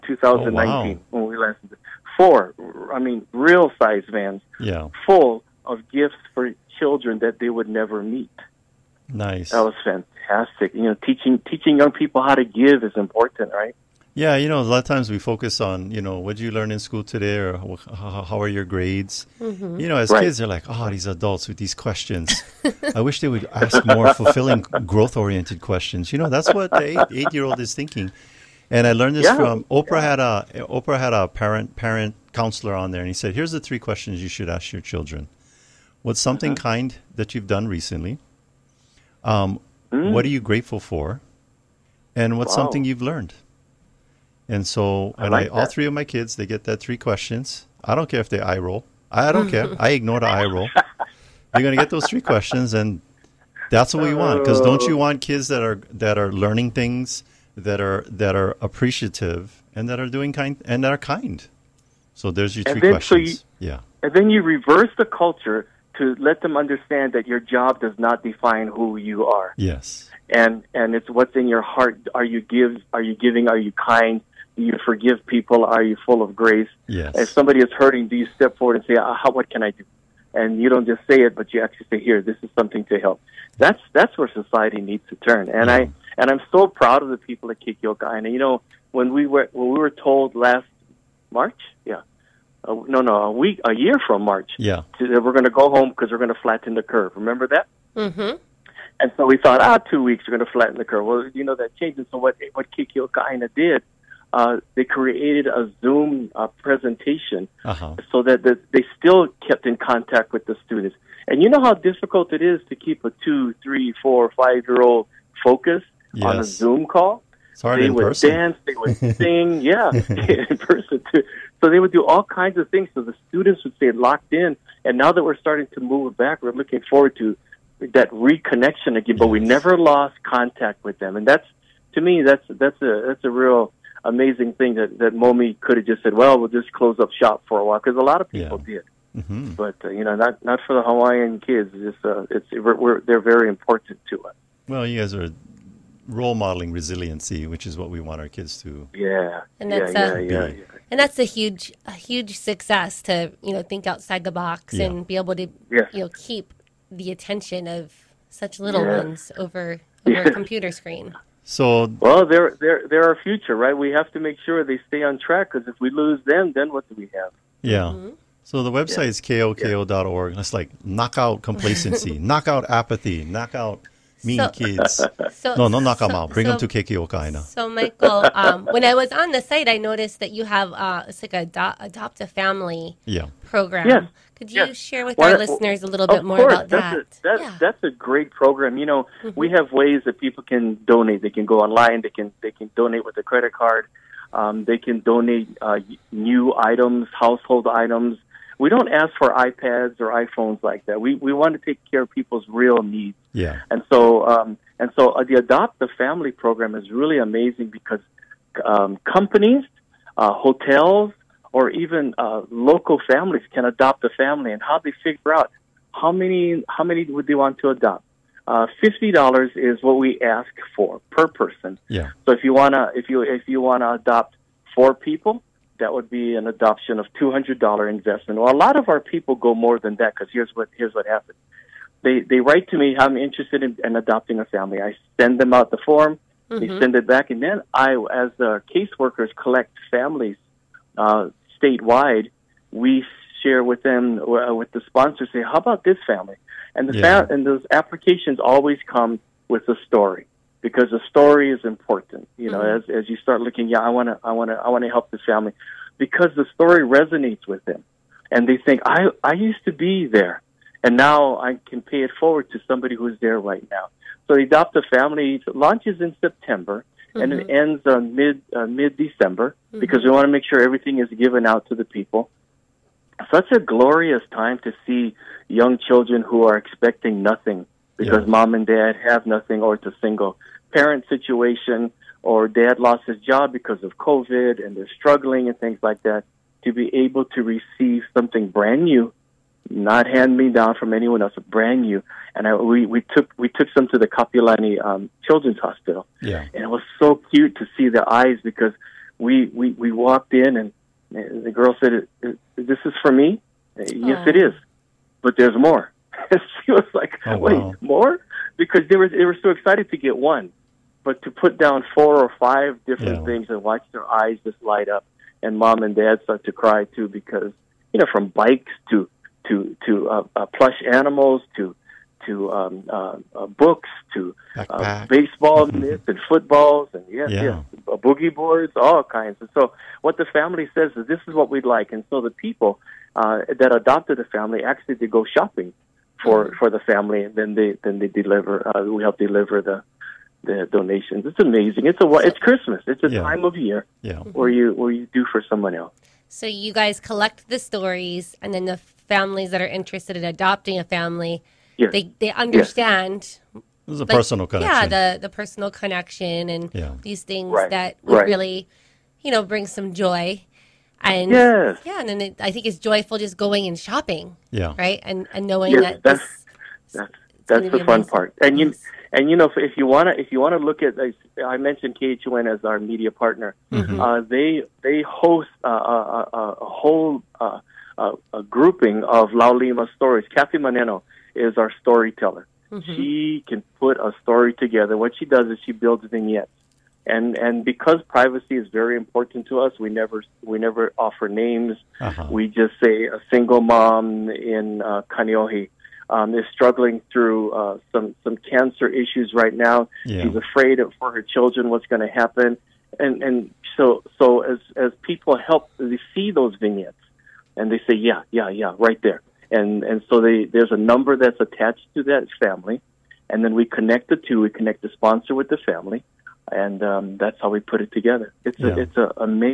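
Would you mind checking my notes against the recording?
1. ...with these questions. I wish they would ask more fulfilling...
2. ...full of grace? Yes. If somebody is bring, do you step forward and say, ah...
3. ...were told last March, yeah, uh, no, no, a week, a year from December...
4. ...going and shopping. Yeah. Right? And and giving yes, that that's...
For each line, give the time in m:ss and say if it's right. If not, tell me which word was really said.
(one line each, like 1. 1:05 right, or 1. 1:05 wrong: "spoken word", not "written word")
1. 0:21 right
2. 1:16 wrong: "hurting", not "bring"
3. 1:29 wrong: "March", not "December"
4. 6:03 wrong: "knowing", not "giving".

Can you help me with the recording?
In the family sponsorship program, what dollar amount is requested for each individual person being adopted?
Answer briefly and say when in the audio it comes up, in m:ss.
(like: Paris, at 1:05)
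$50, at 3:38.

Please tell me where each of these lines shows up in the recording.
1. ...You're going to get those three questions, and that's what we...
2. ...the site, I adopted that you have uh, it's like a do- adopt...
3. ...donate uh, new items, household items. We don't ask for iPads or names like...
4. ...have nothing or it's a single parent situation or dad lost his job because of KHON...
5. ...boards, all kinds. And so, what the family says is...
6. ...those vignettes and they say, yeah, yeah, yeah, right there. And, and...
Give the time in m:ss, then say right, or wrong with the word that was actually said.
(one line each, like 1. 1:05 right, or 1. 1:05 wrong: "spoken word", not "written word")
1. 0:51 right
2. 2:59 wrong: "noticed", not "adopted"
3. 3:15 wrong: "iPhones", not "names"
4. 4:39 wrong: "COVID", not "KHON"
5. 5:28 right
6. 6:46 right.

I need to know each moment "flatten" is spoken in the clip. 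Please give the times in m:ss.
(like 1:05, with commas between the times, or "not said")
1:36, 1:40.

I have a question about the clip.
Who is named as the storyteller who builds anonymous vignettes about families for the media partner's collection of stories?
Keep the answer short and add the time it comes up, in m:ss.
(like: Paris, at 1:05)
Kathy Muneno, at 6:20.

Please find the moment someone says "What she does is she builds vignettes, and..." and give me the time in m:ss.
6:24.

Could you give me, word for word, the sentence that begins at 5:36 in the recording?
for the family, and then they then they deliver.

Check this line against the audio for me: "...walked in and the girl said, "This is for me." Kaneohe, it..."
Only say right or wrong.
wrong.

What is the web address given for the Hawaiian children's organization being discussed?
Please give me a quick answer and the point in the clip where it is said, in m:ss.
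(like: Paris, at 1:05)
koka.org, at 2:49.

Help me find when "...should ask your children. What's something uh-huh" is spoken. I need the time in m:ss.
0:34.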